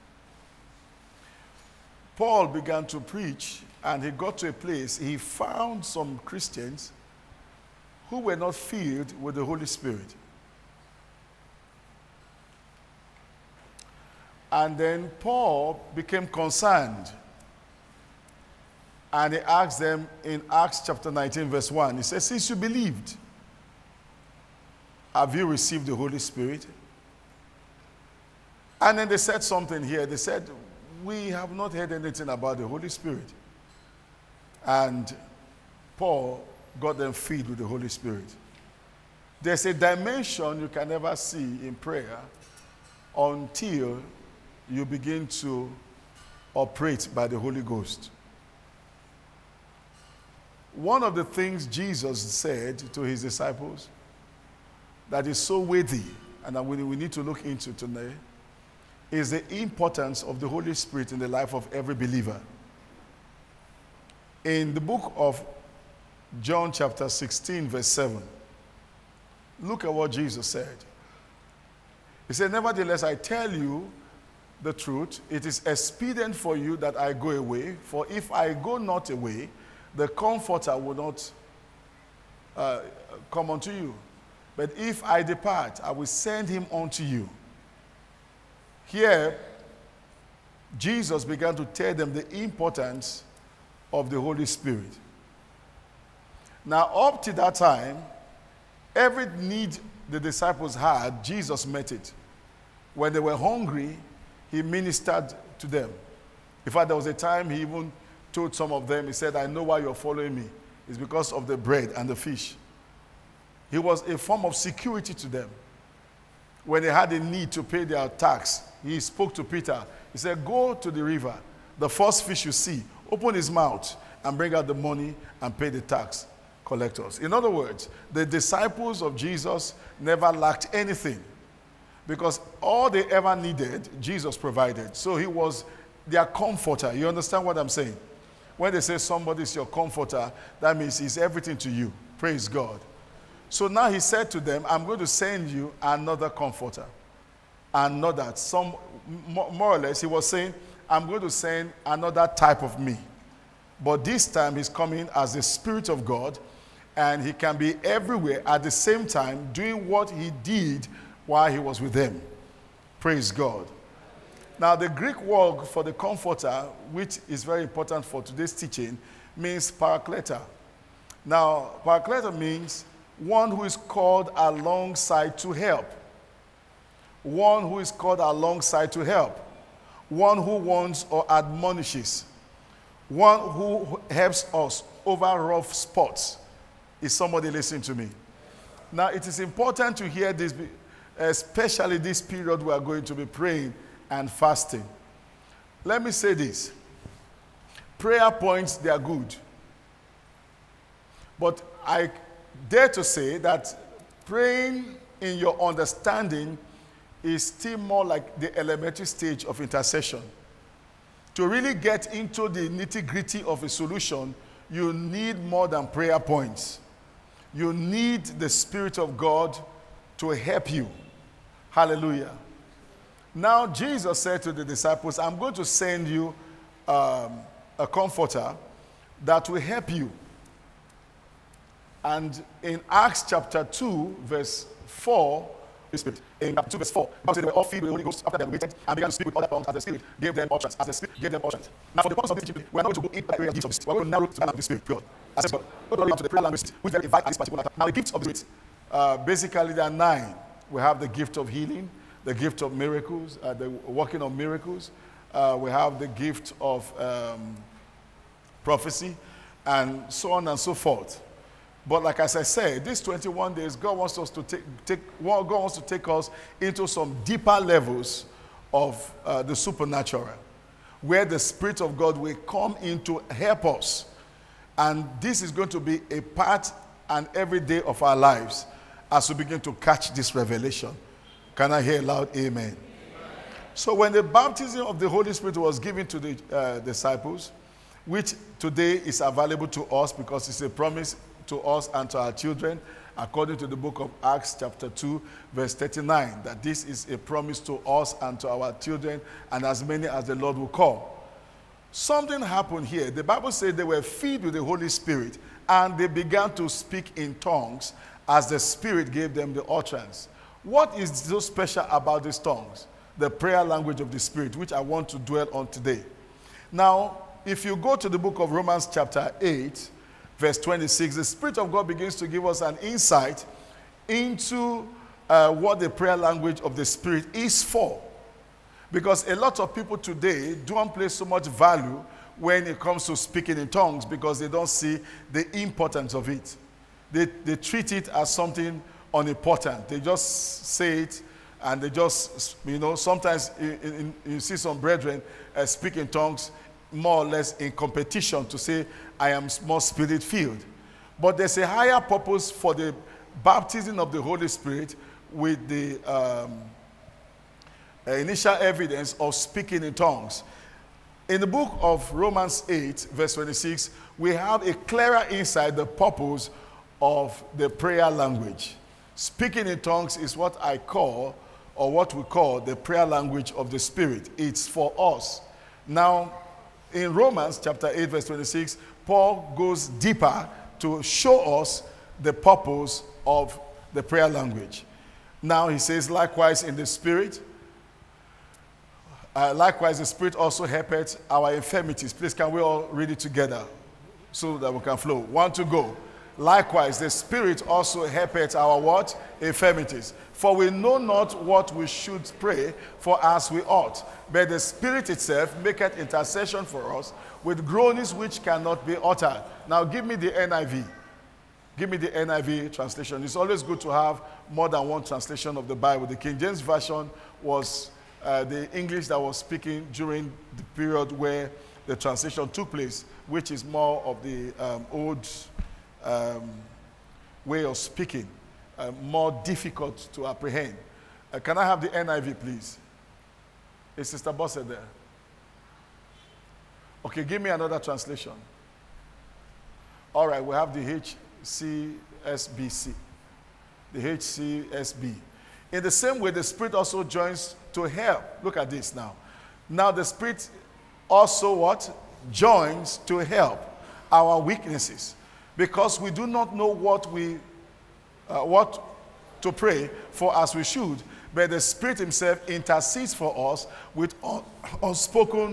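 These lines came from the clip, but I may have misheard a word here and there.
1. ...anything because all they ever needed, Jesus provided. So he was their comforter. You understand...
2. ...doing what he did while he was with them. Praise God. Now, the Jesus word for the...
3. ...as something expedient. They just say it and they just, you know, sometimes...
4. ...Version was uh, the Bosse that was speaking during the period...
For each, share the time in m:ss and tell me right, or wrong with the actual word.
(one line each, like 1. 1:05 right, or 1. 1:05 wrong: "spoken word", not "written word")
1. 2:10 right
2. 2:39 wrong: "Greek", not "Jesus"
3. 5:38 wrong: "unimportant", not "expedient"
4. 6:56 wrong: "English", not "Bosse".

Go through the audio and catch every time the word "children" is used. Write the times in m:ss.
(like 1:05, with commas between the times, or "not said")
4:52, 4:58.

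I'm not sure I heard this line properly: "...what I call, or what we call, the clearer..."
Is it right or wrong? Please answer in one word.
wrong.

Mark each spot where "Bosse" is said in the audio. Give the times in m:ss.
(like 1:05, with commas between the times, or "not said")
7:14.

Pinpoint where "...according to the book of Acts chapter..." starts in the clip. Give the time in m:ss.
4:53.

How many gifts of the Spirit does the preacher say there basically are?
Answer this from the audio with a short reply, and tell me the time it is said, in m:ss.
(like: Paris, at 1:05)
9, at 4:09.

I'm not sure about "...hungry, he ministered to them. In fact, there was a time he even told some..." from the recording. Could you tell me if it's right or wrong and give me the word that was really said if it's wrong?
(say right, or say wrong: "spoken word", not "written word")
right.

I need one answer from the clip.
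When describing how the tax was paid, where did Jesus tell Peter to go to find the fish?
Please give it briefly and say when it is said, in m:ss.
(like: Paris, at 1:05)
The river, at 2:00.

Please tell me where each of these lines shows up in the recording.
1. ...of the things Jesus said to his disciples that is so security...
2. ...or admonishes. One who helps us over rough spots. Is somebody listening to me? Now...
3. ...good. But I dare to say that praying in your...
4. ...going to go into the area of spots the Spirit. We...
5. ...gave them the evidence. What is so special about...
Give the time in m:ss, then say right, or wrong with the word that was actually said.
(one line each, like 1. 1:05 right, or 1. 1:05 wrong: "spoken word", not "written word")
1. 0:51 wrong: "weighty", not "security"
2. 3:01 right
3. 3:18 right
4. 4:02 wrong: "gifts", not "spots"
5. 5:09 wrong: "utterance", not "evidence".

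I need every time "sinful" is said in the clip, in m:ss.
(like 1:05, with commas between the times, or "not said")
not said.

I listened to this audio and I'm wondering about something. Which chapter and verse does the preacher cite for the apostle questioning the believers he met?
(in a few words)
Acts 19:1.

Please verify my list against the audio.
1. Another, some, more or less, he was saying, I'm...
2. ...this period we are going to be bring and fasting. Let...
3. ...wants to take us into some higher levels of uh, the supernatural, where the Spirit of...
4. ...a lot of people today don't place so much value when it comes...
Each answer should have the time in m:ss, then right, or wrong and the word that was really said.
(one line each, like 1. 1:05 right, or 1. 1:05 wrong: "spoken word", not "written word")
1. 2:27 right
2. 3:11 wrong: "praying", not "bring"
3. 4:25 wrong: "deeper", not "higher"
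4. 5:29 right.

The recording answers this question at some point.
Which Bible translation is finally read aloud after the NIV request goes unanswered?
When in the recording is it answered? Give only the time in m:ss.
7:23.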